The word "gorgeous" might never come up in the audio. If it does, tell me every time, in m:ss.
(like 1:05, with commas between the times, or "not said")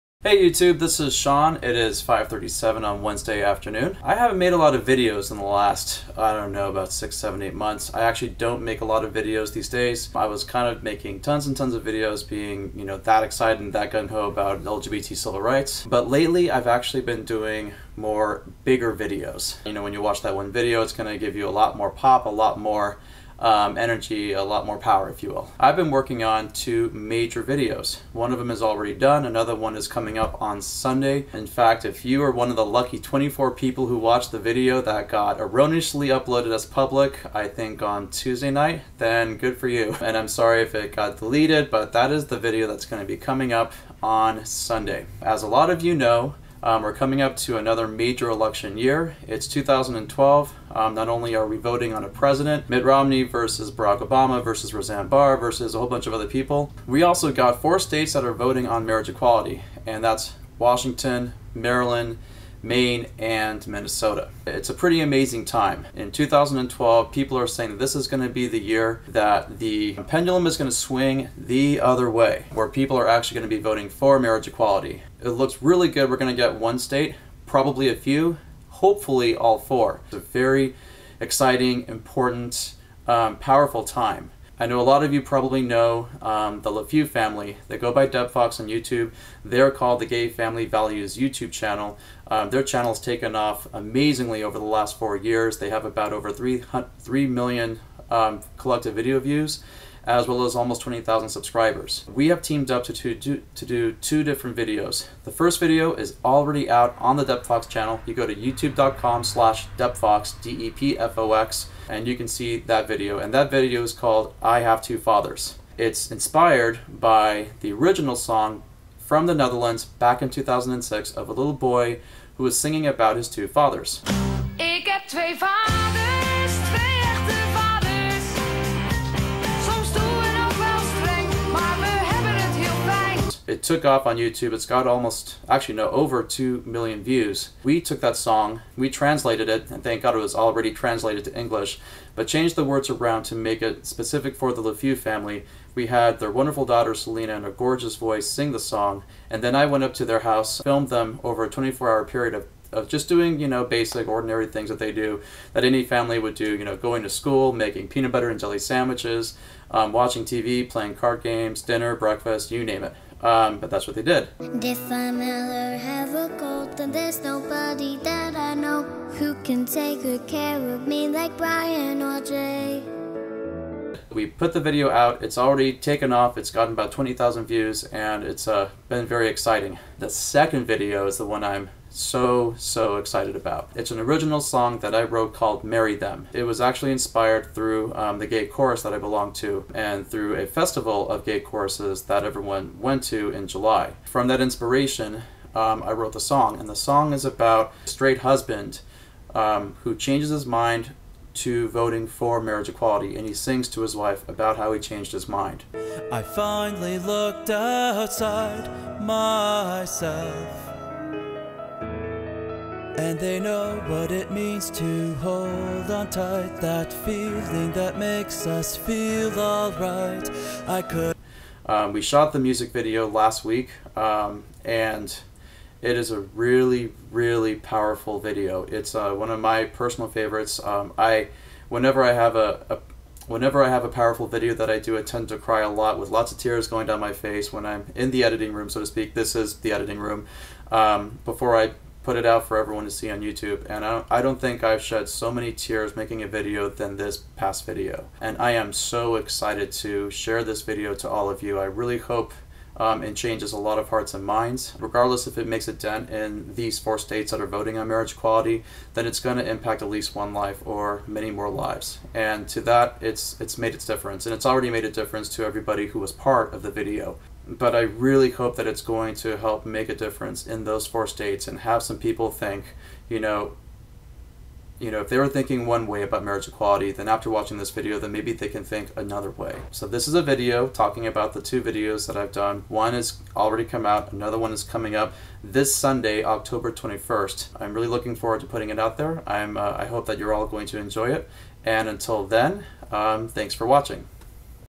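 2:27.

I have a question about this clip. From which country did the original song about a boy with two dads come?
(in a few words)
the Netherlands.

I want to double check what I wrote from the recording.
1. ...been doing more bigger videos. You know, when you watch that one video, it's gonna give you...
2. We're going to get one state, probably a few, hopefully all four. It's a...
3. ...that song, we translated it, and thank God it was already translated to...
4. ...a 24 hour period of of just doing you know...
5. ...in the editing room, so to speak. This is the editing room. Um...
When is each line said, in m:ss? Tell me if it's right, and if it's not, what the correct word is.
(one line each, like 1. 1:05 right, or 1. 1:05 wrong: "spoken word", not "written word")
1. 0:17 right
2. 1:16 right
3. 2:18 right
4. 2:31 right
5. 3:57 right.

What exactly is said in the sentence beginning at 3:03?
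It's an original song that I wrote called Marry Them.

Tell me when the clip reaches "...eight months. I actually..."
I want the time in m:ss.
0:07.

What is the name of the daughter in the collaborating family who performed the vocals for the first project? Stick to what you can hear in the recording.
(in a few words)
Selena.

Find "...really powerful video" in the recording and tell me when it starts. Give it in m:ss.
3:47.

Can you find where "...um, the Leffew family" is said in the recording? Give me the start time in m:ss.
1:26.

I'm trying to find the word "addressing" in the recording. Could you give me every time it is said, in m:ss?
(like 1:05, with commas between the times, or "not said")
not said.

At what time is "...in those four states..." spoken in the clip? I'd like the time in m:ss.
4:30.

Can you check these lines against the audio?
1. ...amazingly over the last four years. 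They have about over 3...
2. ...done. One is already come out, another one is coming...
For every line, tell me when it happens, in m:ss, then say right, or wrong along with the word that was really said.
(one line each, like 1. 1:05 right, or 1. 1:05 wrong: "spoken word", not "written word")
1. 1:33 right
2. 4:42 right.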